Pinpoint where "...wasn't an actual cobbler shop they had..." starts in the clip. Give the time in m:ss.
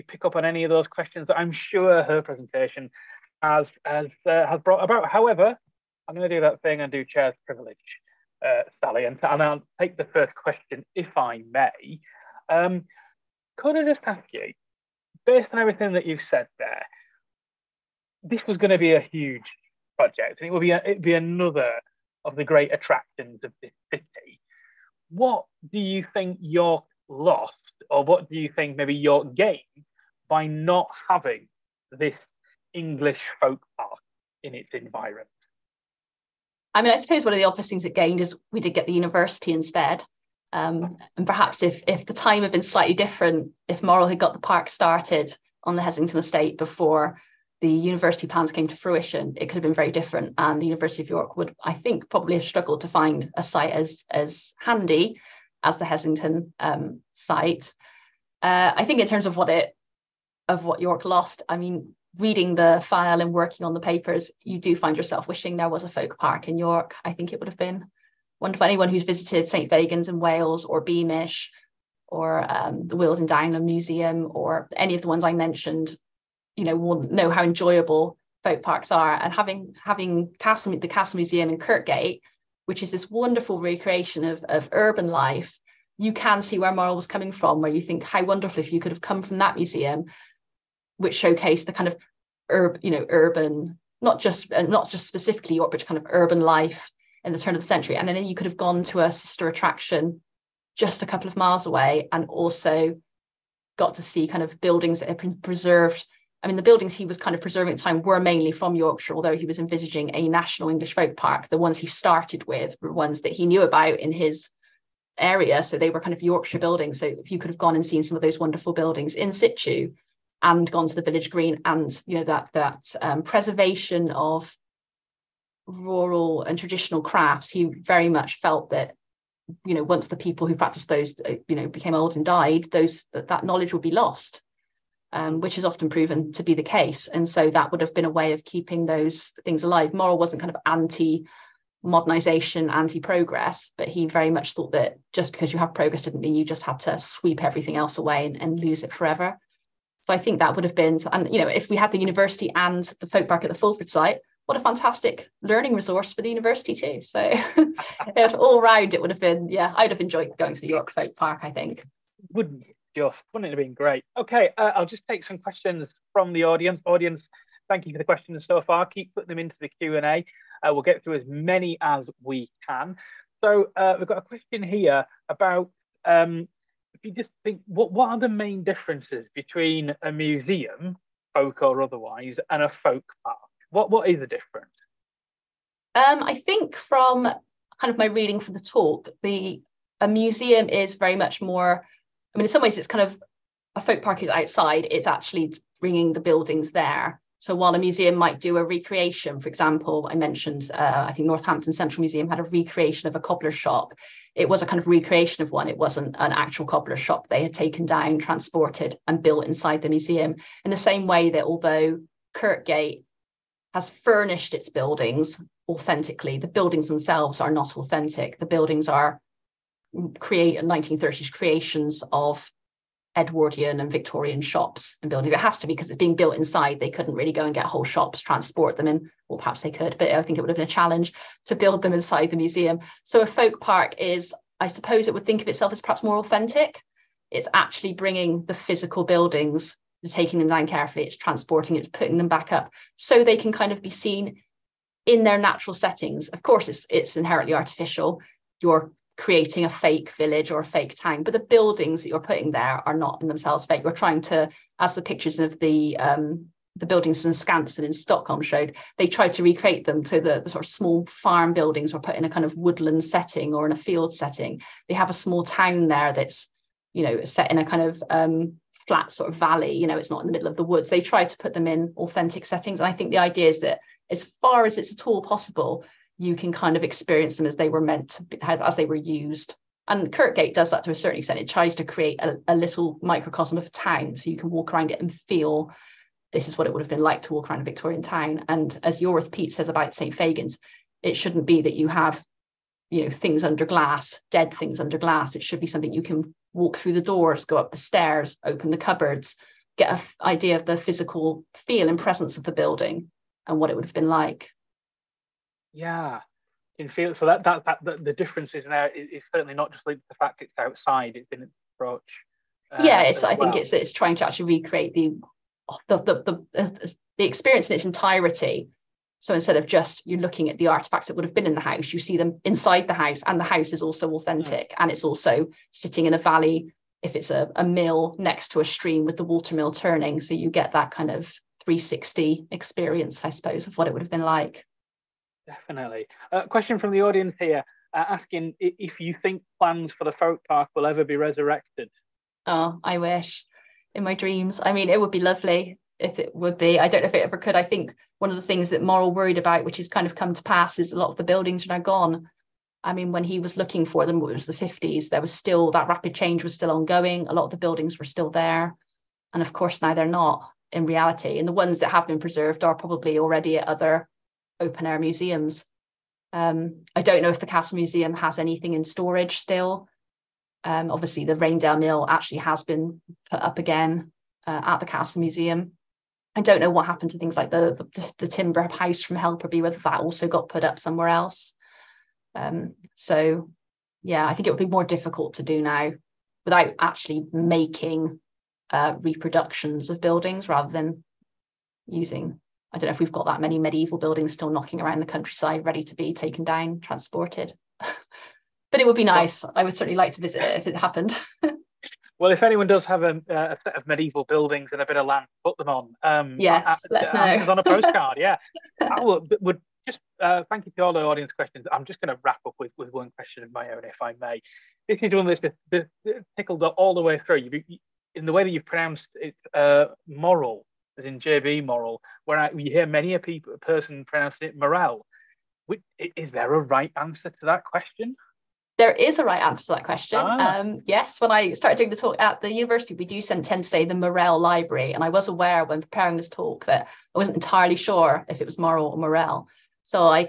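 3:25.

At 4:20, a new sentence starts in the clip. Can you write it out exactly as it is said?
So the, the, sort of small farm buildings were put in a kind of woodland setting or in a field setting.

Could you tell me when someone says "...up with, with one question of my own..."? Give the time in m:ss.
6:52.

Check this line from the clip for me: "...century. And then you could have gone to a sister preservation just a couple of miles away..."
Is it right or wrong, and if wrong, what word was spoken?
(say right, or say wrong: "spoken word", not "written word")
wrong: "attraction", not "preservation".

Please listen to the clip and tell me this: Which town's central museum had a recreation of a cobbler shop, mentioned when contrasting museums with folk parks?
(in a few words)
Northampton.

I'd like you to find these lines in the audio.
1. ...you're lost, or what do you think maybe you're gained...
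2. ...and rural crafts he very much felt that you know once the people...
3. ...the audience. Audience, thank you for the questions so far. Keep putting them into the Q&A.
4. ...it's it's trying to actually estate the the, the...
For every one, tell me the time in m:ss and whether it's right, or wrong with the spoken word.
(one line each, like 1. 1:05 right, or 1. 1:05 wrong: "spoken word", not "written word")
1. 0:26 right
2. 2:06 wrong: "traditional", not "rural"
3. 2:46 right
4. 5:13 wrong: "recreate", not "estate".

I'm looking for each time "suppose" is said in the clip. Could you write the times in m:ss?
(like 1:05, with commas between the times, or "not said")
0:36, 3:54, 5:33.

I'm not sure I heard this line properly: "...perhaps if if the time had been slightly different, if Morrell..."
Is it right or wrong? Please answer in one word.
right.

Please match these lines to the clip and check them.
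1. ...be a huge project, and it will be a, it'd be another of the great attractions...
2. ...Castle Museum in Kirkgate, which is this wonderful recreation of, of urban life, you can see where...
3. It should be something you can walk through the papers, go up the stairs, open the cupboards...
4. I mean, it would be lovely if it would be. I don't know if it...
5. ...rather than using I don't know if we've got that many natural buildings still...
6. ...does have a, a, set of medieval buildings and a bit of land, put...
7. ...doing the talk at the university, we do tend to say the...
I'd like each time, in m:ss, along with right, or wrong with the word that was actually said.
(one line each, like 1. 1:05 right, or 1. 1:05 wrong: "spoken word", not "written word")
1. 0:18 right
2. 1:20 right
3. 4:55 wrong: "doors", not "papers"
4. 5:44 right
5. 6:30 wrong: "medieval", not "natural"
6. 6:42 right
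7. 7:11 right.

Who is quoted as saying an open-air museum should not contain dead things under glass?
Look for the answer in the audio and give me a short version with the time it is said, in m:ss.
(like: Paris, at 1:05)
Iorwerth Peate, at 4:49.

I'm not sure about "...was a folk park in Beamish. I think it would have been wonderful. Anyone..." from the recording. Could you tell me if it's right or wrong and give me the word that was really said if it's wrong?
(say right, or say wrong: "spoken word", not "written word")
wrong: "York", not "Beamish".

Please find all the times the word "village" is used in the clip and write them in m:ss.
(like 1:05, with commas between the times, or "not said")
2:01, 4:10.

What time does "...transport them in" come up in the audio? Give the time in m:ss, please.
3:48.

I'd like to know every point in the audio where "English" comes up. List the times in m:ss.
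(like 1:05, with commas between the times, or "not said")
0:32, 1:50.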